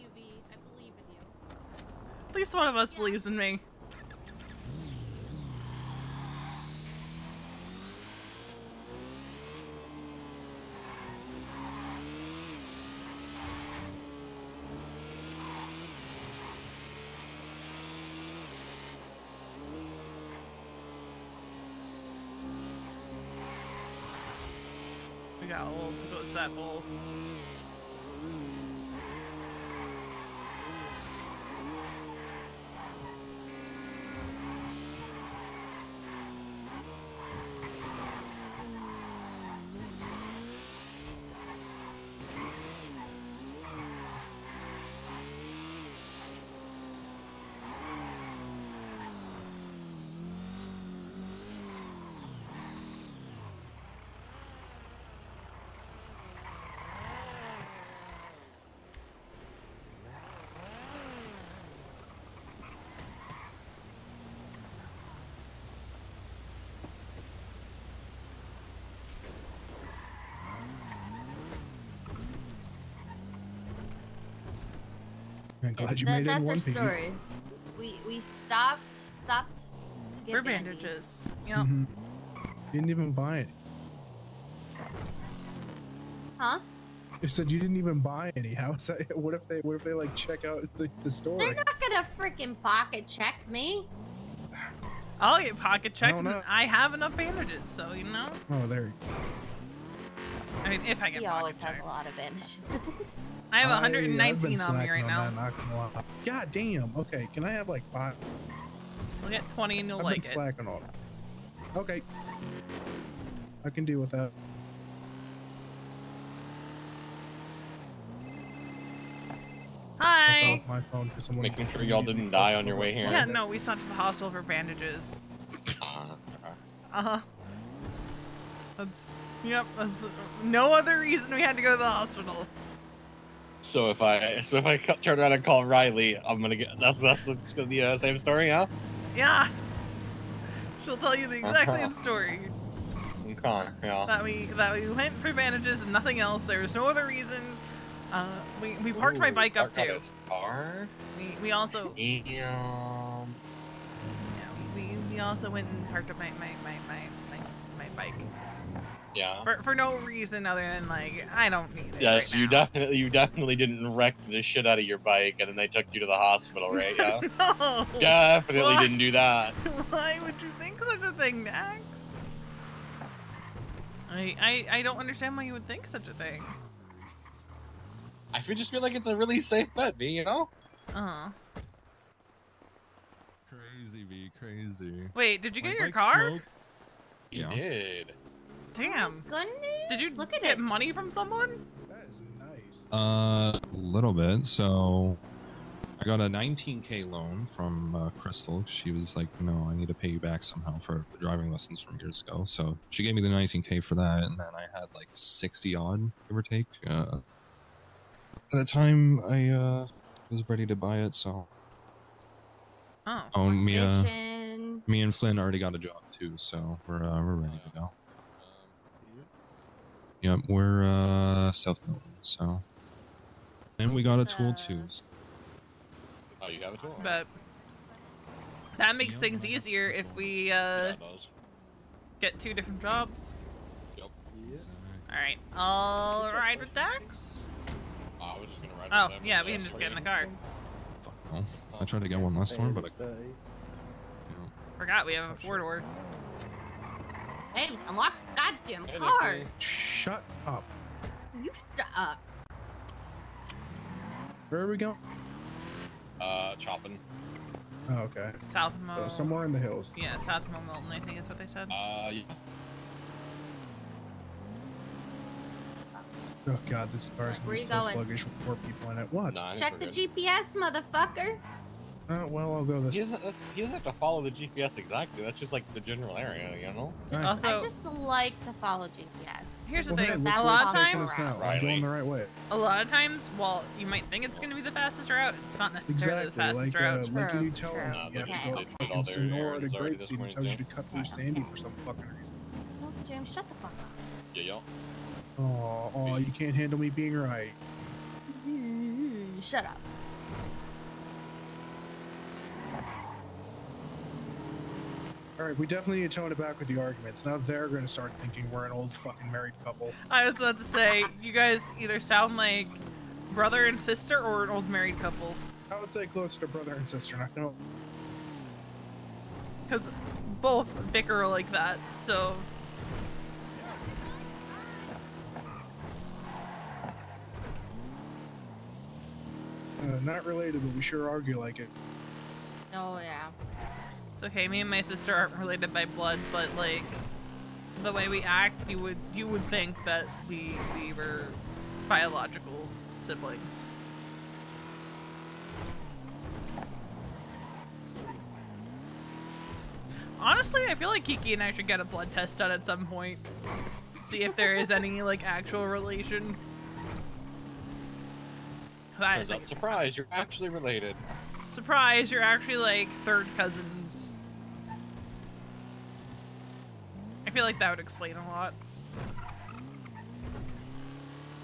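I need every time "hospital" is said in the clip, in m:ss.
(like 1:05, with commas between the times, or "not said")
2:03, 2:11, 2:46.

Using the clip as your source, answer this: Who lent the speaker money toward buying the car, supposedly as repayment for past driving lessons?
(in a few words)
Crystal.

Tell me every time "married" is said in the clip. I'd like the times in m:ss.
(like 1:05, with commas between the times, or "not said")
5:09, 5:14.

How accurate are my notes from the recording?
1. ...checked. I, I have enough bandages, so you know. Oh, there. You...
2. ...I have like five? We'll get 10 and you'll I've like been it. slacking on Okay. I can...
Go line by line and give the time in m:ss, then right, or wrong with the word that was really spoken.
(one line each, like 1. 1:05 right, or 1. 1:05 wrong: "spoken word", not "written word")
1. 1:35 right
2. 1:47 wrong: "20", not "10".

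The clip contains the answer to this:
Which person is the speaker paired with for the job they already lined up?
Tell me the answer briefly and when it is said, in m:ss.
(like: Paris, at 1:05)
Flynn, at 3:35.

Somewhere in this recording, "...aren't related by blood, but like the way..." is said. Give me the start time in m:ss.
5:35.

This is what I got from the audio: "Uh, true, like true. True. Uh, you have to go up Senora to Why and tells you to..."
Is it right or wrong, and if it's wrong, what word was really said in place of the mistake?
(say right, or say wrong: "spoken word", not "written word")
wrong: "Grapeseed", not "Why".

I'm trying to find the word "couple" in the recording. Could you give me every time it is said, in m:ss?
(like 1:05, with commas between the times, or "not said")
5:09, 5:15.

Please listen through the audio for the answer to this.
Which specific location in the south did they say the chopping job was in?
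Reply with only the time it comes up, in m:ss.
4:20.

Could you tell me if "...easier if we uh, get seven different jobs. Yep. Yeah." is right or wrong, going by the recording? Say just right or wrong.
wrong.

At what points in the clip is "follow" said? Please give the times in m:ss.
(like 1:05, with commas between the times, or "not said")
4:33, 4:38.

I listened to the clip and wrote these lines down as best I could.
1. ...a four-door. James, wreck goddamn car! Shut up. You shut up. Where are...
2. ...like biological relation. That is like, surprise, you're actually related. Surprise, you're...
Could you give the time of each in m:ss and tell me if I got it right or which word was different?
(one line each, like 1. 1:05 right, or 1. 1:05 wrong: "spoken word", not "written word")
1. 4:05 wrong: "unlock", not "wreck"
2. 5:55 wrong: "actual", not "biological".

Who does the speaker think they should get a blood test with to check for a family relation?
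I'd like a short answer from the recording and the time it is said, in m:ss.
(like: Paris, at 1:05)
Kiki, at 5:51.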